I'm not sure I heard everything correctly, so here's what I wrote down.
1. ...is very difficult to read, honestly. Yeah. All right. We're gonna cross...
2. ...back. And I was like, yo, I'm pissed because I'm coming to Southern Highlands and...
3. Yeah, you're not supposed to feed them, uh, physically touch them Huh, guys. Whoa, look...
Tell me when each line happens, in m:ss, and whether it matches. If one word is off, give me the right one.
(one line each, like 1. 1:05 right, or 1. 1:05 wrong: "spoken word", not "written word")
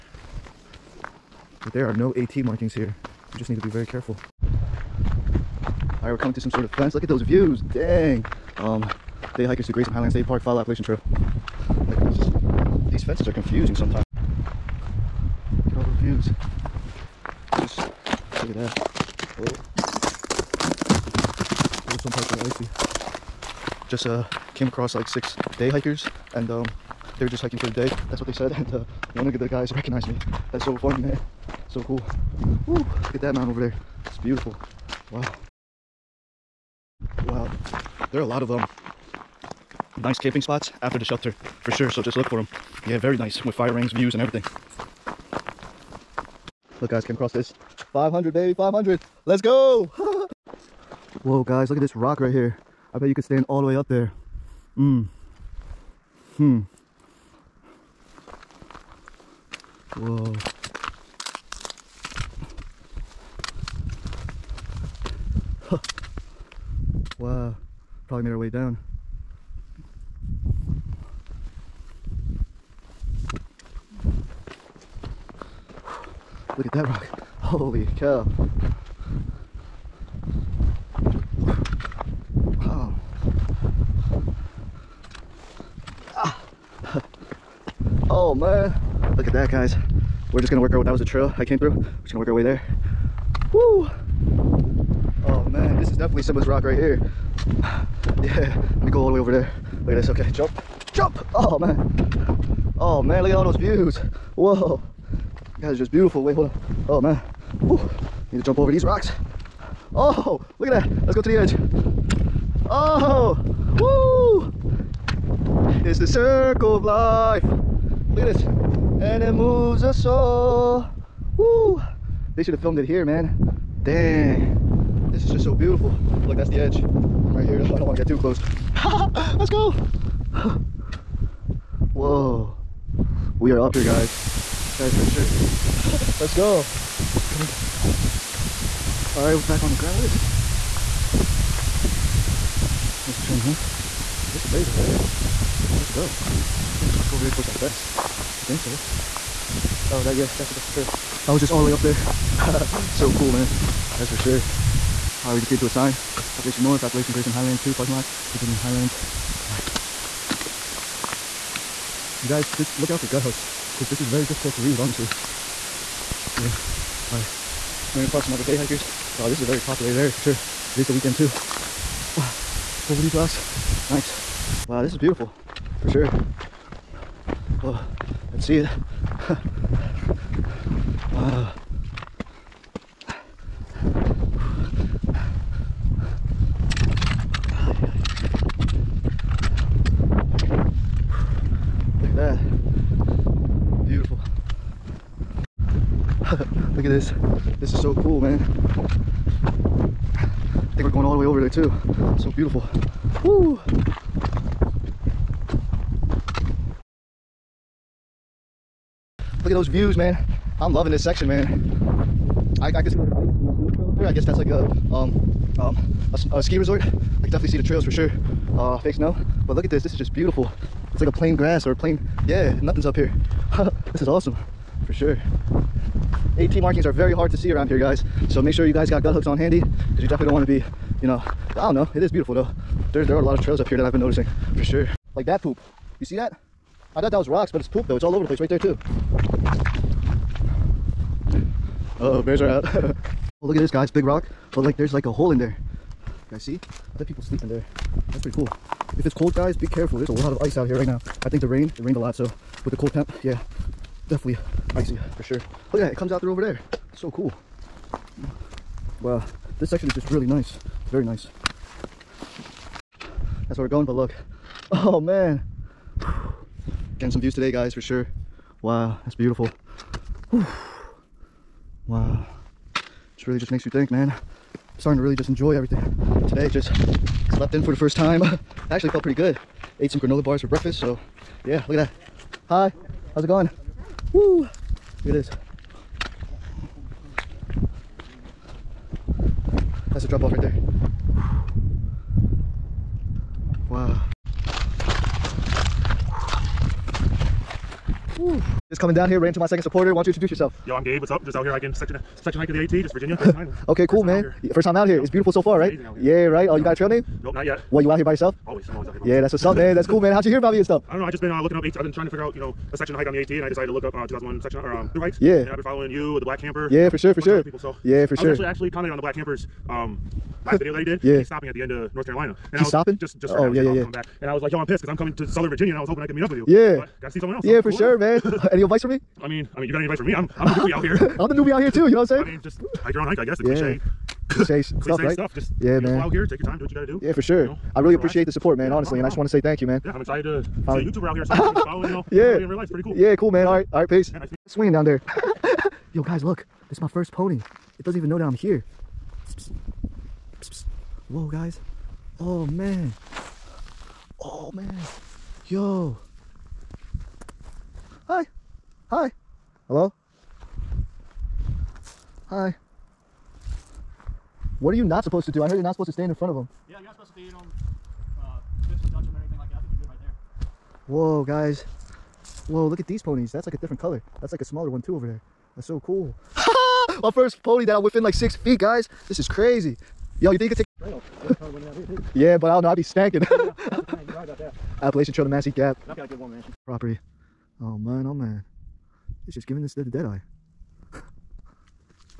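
1. 2:44 right
2. 5:23 wrong: "Virginia", not "Highlands"
3. 6:06 wrong: "Whoa", not "Huh".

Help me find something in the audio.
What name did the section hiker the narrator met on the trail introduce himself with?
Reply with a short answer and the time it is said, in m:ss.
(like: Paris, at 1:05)
Gabe, at 5:00.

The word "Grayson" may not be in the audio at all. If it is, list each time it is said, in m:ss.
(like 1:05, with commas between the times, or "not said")
0:09, 2:37, 5:03.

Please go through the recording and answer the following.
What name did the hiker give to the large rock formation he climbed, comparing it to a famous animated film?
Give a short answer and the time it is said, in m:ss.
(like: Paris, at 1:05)
Simba's Rock, at 1:36.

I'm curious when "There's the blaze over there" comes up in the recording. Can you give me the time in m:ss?
2:24.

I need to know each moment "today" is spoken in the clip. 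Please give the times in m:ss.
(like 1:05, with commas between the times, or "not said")
4:27, 4:36.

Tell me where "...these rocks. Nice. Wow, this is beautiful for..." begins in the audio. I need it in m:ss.
2:53.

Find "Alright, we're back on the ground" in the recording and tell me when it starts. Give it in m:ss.
2:19.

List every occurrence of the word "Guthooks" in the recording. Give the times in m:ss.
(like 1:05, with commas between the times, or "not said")
2:43, 3:49.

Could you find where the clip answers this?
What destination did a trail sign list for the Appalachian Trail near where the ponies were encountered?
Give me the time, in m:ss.
6:25.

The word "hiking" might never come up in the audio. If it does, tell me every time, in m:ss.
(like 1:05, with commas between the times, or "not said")
0:27, 5:01.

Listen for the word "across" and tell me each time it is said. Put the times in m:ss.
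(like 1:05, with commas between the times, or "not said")
0:24, 0:47.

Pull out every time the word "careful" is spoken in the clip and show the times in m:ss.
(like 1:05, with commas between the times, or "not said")
0:03, 4:09.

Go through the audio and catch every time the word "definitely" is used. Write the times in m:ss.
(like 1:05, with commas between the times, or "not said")
1:35, 3:37, 3:50, 4:14.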